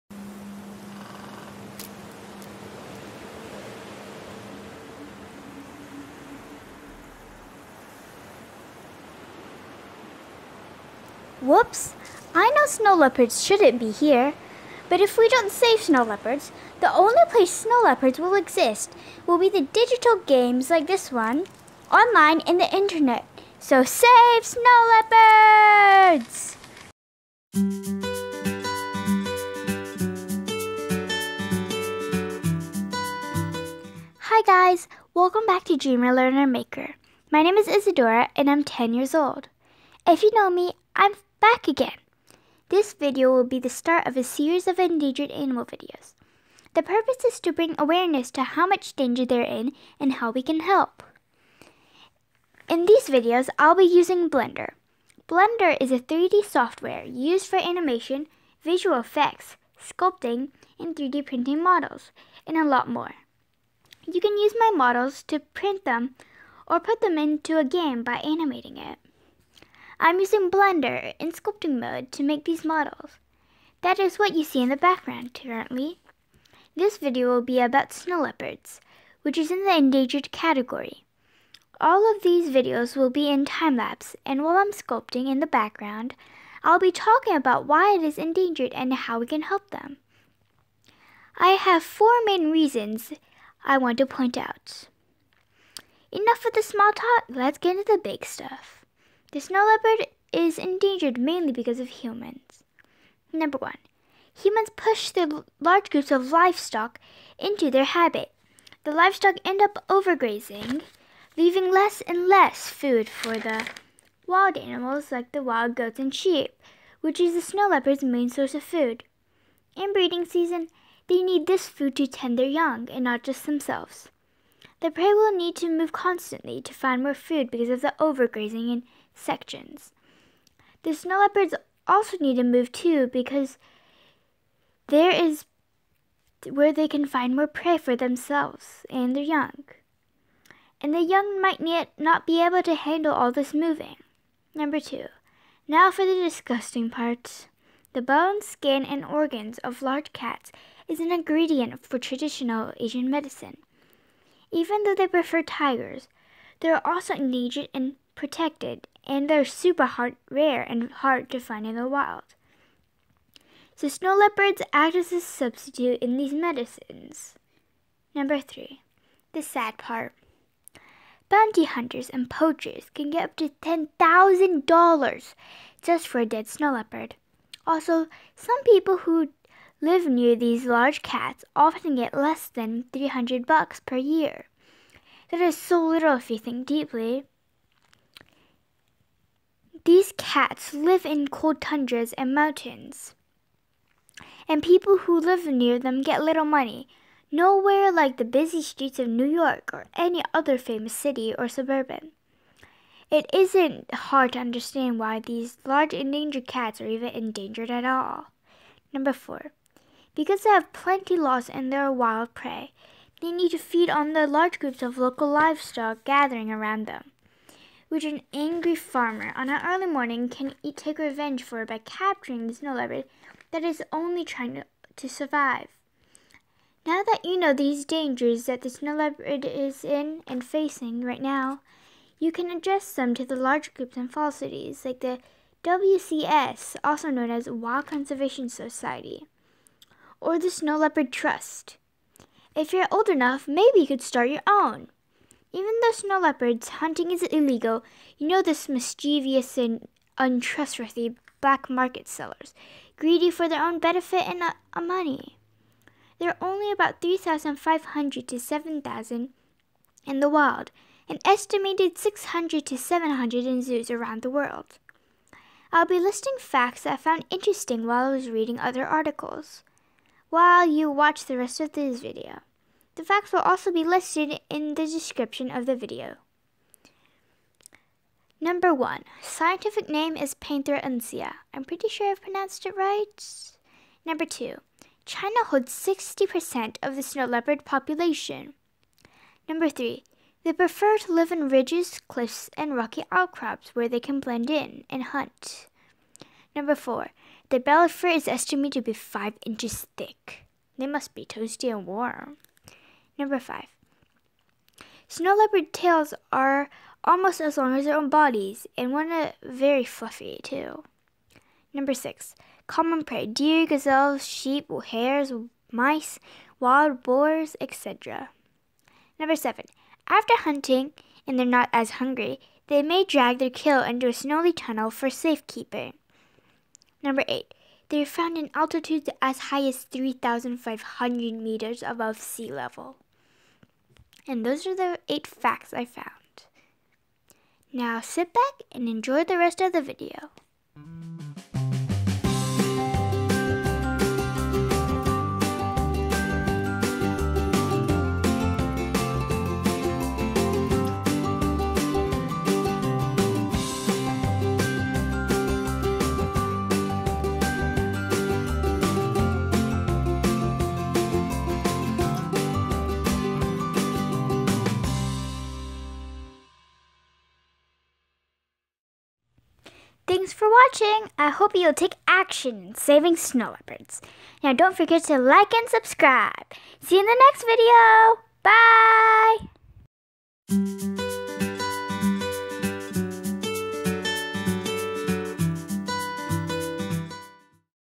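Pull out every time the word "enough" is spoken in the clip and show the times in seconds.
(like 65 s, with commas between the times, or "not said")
96 s, 243 s.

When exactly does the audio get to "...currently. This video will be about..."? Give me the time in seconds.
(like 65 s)
75 s.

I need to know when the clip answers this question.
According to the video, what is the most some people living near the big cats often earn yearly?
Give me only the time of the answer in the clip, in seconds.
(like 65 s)
182 s.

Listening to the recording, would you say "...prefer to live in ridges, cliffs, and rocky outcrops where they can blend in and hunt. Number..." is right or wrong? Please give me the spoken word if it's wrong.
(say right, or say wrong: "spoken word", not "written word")
right.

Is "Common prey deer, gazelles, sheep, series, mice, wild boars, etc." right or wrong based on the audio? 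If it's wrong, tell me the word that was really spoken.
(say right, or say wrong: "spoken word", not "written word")
wrong: "hares", not "series".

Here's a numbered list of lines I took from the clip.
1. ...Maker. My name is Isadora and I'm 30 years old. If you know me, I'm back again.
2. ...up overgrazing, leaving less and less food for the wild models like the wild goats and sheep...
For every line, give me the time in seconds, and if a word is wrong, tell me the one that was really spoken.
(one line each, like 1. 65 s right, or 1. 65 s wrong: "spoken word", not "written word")
1. 36 s wrong: "10", not "30"
2. 109 s wrong: "animals", not "models".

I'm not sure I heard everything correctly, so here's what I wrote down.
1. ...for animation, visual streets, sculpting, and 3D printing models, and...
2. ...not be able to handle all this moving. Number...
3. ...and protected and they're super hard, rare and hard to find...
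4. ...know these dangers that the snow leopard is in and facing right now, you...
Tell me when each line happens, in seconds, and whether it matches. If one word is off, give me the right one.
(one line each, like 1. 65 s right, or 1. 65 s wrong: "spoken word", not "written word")
1. 57 s wrong: "effects", not "streets"
2. 141 s right
3. 157 s right
4. 227 s right.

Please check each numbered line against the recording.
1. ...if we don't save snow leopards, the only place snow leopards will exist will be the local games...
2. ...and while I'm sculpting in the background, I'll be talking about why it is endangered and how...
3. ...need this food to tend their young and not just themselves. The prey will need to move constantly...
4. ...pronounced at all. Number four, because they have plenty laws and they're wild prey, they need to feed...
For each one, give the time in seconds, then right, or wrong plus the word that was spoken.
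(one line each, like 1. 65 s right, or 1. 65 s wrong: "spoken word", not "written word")
1. 15 s wrong: "digital", not "local"
2. 84 s right
3. 121 s right
4. 207 s wrong: "endangered", not "pronounced".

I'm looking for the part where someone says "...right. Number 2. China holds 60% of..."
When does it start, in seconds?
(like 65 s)
282 s.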